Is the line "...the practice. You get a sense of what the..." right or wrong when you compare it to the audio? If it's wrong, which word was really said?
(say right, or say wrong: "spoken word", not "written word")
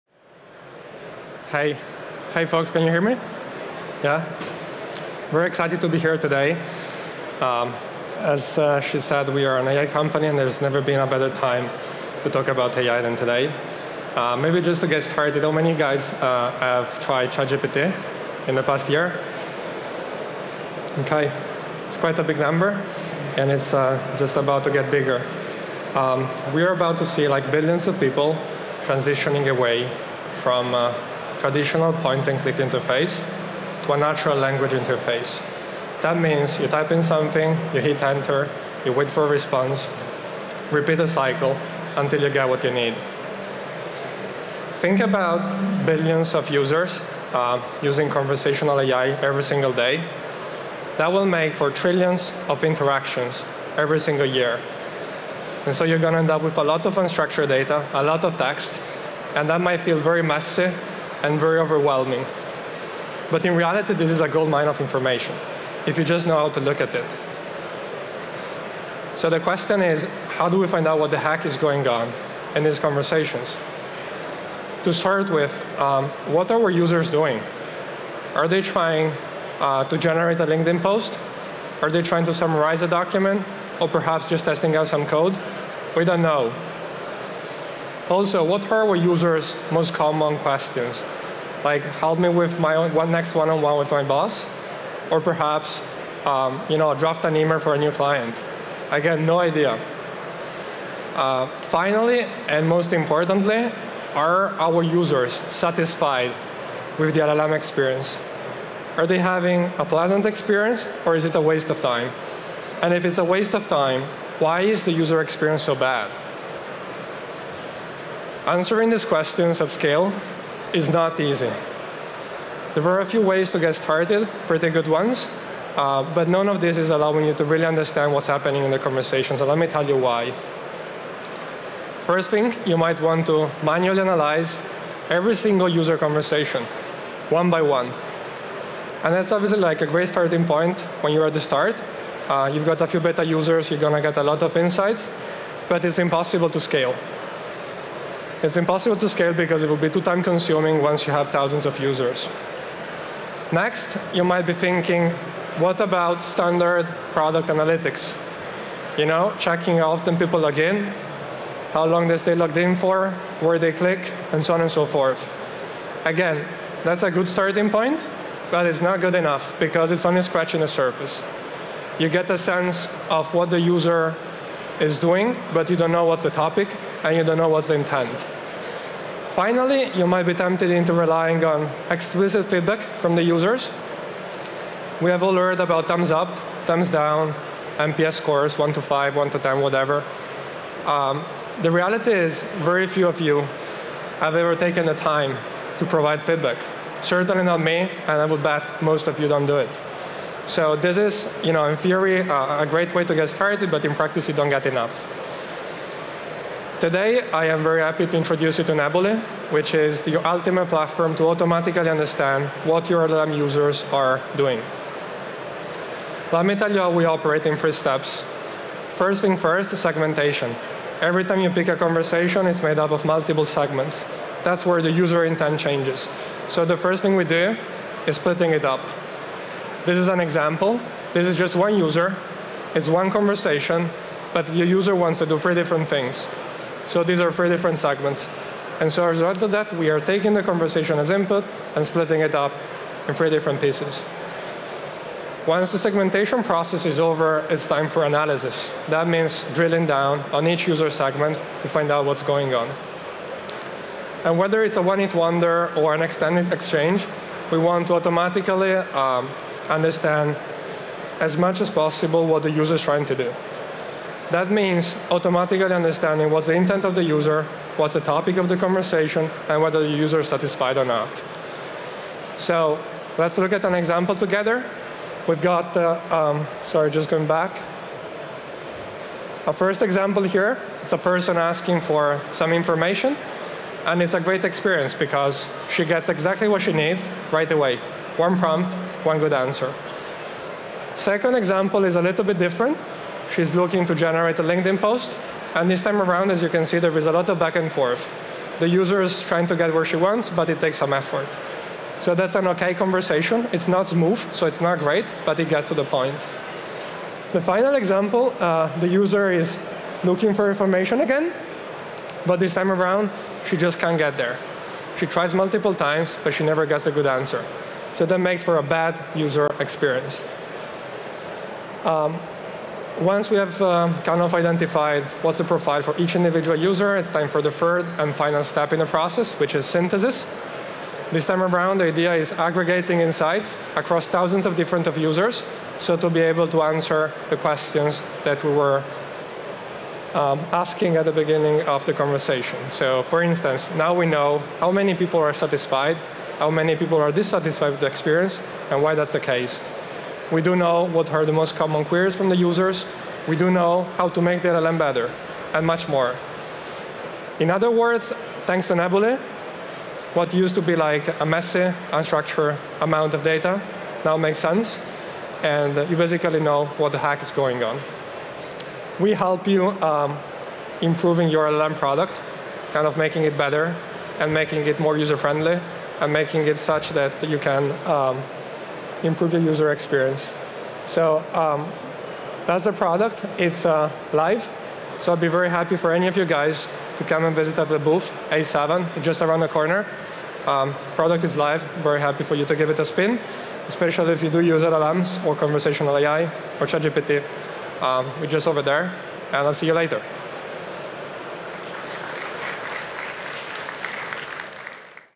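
wrong: "surface", not "practice".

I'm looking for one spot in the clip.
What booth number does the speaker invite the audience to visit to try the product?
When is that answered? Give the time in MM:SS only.
06:28.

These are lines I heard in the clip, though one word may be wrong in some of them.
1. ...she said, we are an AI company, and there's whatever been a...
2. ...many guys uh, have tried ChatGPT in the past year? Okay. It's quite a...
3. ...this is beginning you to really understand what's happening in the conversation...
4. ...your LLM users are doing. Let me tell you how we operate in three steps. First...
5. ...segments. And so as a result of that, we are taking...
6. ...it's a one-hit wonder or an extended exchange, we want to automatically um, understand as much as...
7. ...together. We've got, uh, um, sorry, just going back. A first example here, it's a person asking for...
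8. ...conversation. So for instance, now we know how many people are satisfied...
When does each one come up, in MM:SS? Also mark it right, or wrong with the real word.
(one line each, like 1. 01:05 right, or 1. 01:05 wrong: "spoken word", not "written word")
1. 00:08 wrong: "never", not "whatever"
2. 00:15 right
3. 02:06 wrong: "allowing", not "beginning"
4. 03:32 right
5. 03:57 right
6. 04:14 right
7. 04:34 right
8. 05:41 right.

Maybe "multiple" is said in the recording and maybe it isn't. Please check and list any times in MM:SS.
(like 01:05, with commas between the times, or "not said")
03:43, 05:15.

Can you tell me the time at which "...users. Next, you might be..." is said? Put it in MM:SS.
02:31.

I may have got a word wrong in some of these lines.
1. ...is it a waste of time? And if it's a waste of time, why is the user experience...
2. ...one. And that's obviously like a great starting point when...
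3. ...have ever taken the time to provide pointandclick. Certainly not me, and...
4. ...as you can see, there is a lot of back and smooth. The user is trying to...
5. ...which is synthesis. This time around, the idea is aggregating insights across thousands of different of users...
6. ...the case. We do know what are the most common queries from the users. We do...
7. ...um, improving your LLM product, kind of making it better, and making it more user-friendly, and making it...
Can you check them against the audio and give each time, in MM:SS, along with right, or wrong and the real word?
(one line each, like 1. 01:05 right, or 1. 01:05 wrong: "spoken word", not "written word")
1. 01:51 right
2. 02:17 right
3. 03:14 wrong: "feedback", not "pointandclick"
4. 04:56 wrong: "forth", not "smooth"
5. 05:29 right
6. 05:49 right
7. 06:09 right.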